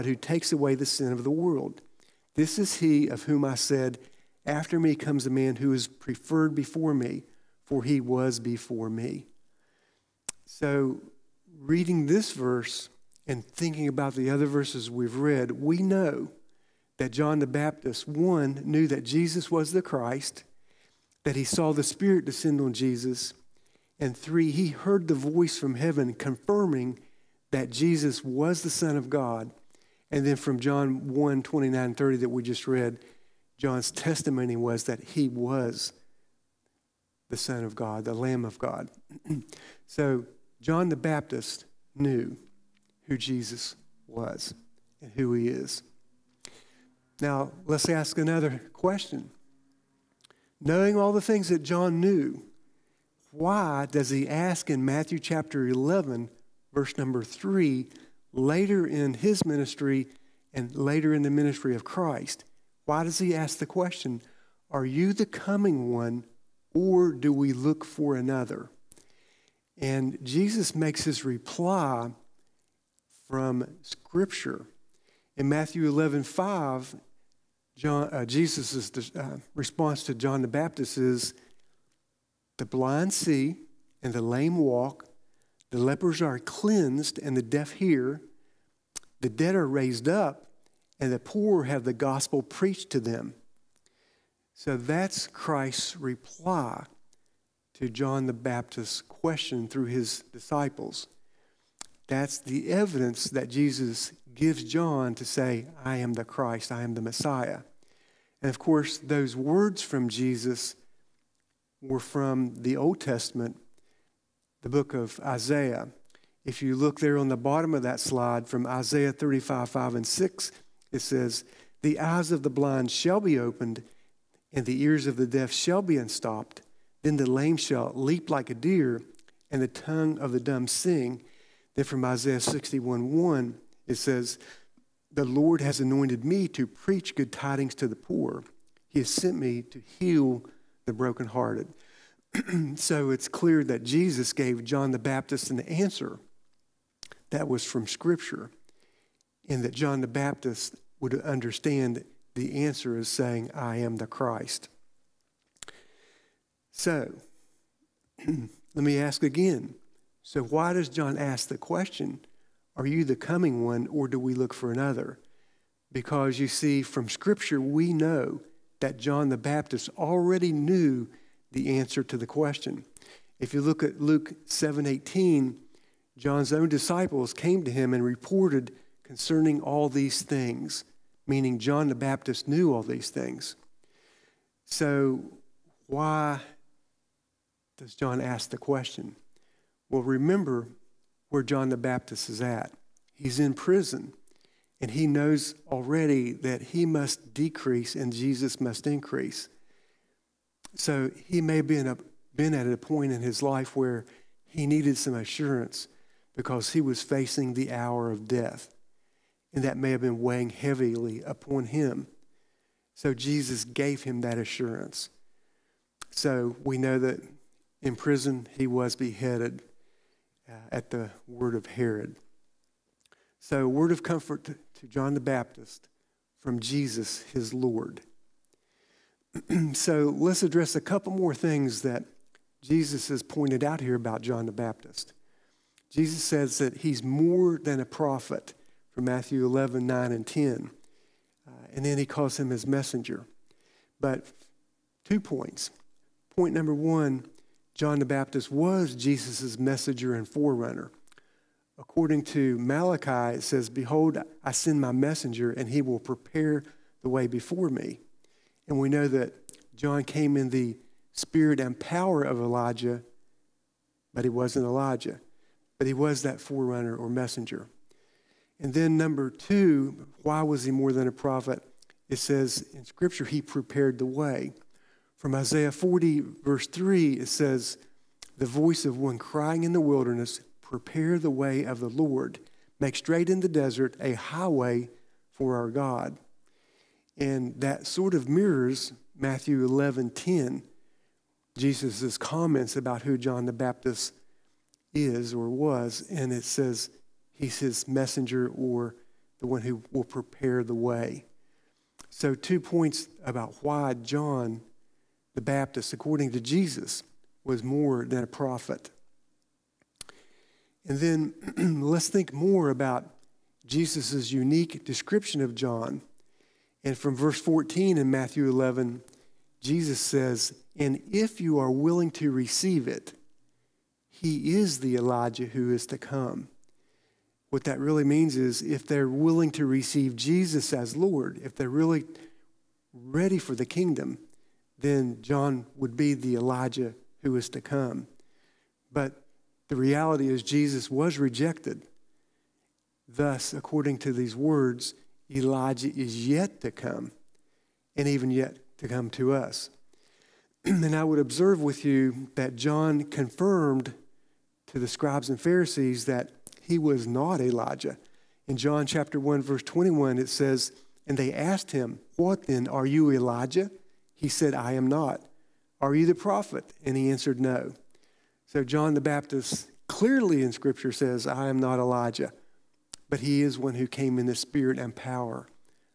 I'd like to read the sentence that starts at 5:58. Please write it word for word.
In John chapter 1, verse 21, it says, And they asked him, What then?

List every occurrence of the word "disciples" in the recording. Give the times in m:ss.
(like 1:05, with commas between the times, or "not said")
1:40, 2:56.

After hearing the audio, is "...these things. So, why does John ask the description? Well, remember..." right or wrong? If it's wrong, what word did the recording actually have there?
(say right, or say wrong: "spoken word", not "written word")
wrong: "question", not "description".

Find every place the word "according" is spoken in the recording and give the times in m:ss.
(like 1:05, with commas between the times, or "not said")
4:11, 5:05, 5:43.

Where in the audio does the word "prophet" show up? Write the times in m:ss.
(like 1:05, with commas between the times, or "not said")
3:57, 4:31, 5:08, 6:06.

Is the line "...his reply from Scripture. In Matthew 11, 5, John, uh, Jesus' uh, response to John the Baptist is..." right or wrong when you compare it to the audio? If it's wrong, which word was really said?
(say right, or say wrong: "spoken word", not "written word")
right.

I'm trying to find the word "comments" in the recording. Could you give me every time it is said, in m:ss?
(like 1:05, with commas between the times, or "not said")
4:52.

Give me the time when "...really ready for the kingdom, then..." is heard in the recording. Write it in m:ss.
5:31.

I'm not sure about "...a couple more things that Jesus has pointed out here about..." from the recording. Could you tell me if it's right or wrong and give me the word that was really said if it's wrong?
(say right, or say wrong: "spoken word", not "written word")
right.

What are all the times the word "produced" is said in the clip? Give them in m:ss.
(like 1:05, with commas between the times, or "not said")
not said.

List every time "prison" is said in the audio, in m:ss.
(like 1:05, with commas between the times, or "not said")
3:13, 3:37.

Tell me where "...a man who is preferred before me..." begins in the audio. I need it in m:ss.
0:05.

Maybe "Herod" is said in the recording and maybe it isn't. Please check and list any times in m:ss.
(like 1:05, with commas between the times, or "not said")
3:41.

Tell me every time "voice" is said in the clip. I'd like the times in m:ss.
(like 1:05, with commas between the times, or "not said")
0:25, 4:38.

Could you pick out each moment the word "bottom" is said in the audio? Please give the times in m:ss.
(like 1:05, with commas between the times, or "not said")
1:57.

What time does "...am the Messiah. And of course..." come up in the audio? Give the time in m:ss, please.
1:46.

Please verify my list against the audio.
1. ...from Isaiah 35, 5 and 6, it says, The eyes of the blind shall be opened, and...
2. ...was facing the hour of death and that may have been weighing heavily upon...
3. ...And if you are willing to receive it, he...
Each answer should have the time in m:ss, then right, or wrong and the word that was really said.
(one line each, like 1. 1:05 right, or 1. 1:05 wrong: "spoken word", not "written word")
1. 1:58 right
2. 3:26 right
3. 5:20 right.